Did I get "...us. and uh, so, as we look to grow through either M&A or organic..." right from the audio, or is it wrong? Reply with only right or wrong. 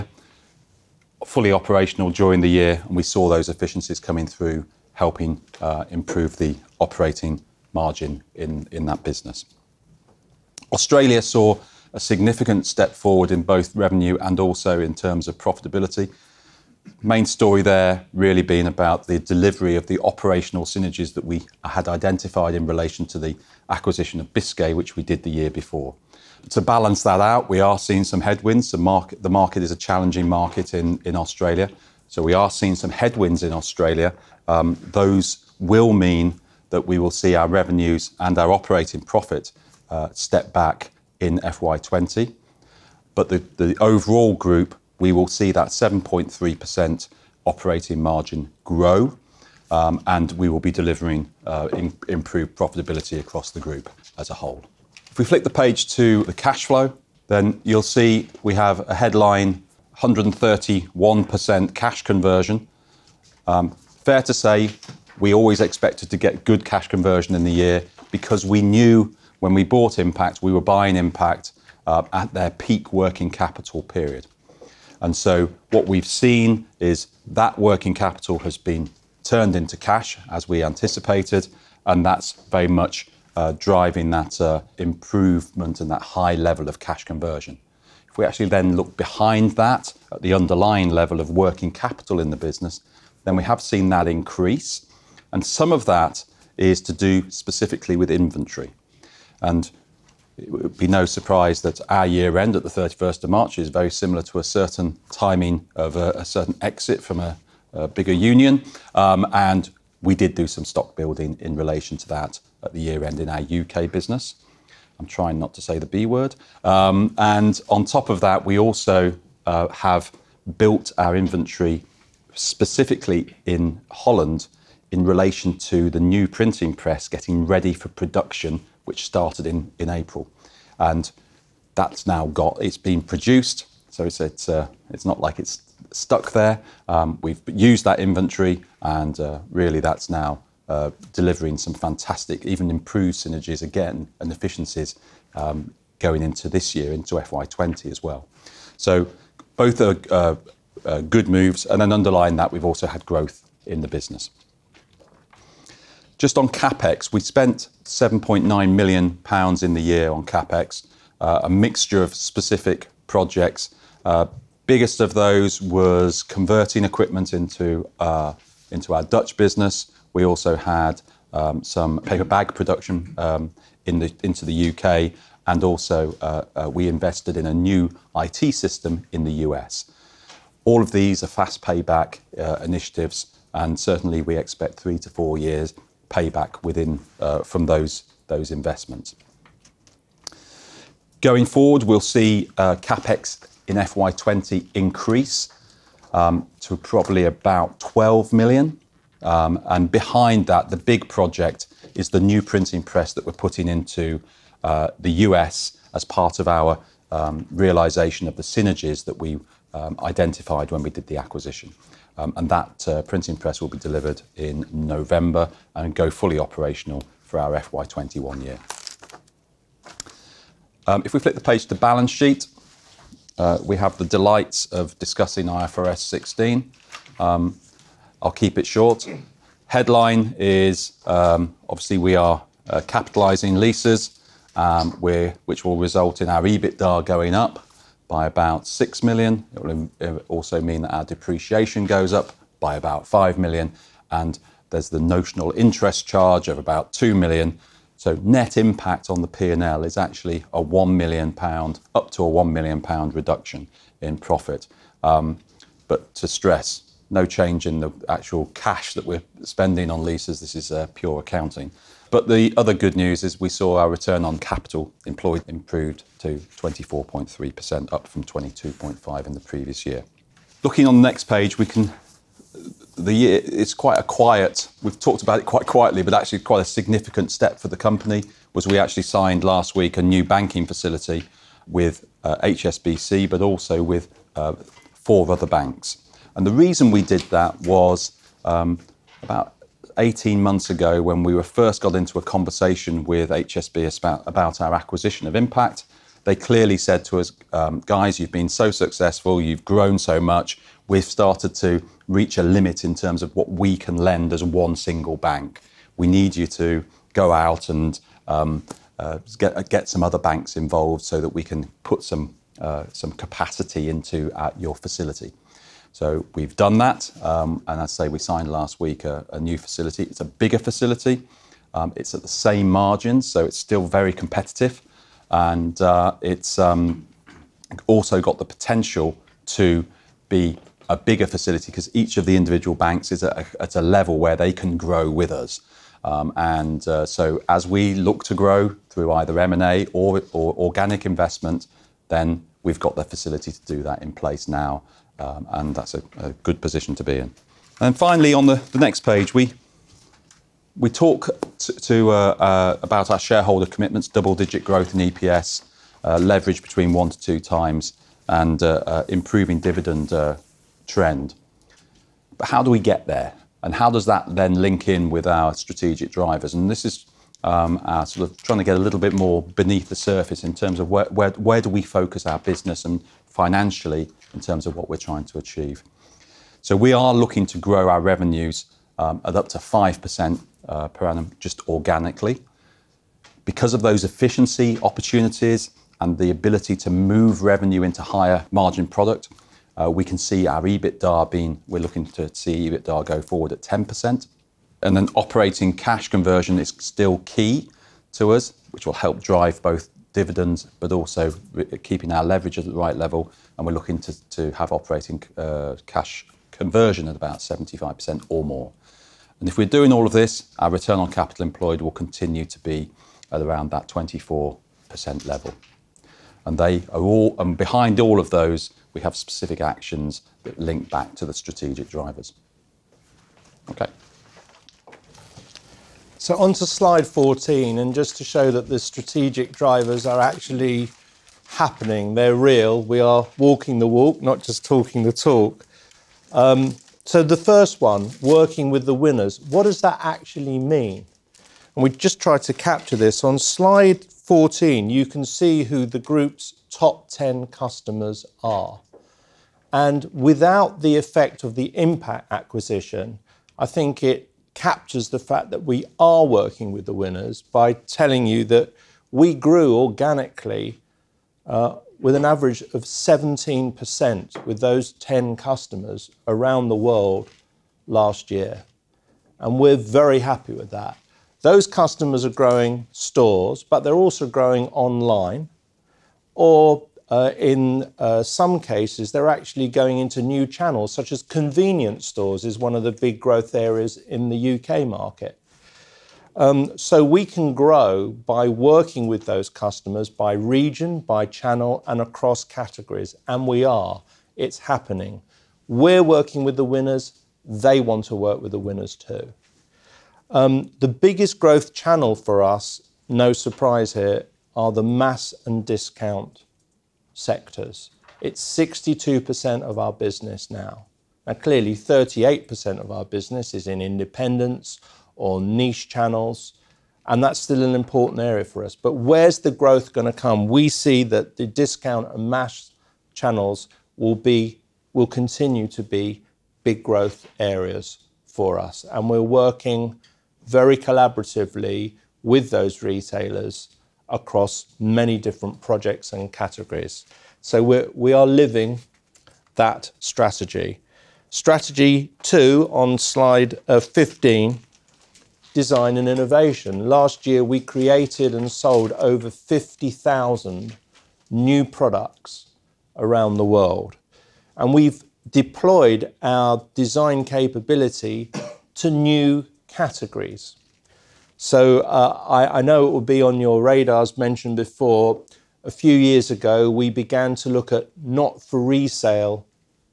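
right.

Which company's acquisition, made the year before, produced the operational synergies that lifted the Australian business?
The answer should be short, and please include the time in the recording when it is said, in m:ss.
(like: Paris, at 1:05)
Biscay, at 0:24.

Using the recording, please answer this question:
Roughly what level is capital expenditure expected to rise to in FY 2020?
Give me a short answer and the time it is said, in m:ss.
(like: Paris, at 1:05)
about 12 million, at 3:17.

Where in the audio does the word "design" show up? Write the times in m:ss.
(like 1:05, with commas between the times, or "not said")
9:05, 9:16.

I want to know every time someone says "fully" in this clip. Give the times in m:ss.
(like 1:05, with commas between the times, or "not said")
0:01, 3:36.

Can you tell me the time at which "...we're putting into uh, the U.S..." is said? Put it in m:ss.
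3:23.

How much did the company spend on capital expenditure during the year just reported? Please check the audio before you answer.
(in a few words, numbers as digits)
7.9 million pounds.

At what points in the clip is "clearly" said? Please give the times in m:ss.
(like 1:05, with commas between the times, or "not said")
4:56, 8:31.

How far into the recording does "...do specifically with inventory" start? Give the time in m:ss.
1:36.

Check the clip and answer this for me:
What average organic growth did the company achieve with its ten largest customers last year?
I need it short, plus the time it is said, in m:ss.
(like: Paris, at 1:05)
17%, at 7:42.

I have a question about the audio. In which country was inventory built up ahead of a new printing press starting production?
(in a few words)
Holland.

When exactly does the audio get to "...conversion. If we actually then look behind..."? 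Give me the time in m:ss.
1:27.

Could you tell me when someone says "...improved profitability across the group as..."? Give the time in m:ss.
0:52.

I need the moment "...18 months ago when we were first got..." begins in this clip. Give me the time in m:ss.
4:49.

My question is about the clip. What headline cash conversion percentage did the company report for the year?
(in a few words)
131%.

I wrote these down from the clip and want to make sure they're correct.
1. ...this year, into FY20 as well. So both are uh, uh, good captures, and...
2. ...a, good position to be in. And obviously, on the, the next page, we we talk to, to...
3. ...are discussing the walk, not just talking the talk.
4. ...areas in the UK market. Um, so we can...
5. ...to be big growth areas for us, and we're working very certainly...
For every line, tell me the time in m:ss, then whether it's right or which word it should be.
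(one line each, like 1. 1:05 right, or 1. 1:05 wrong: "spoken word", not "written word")
1. 2:26 wrong: "moves", not "captures"
2. 5:46 wrong: "finally", not "obviously"
3. 7:12 wrong: "walking", not "discussing"
4. 8:03 right
5. 8:45 wrong: "collaboratively", not "certainly".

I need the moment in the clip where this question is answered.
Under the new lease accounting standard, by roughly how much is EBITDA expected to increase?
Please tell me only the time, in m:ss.
3:58.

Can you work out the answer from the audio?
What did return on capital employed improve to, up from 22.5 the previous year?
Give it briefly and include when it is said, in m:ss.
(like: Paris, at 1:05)
24.3%, at 4:26.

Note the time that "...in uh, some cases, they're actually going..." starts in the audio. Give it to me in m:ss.
7:57.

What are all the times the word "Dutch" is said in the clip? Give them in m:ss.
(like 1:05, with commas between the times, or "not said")
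2:49.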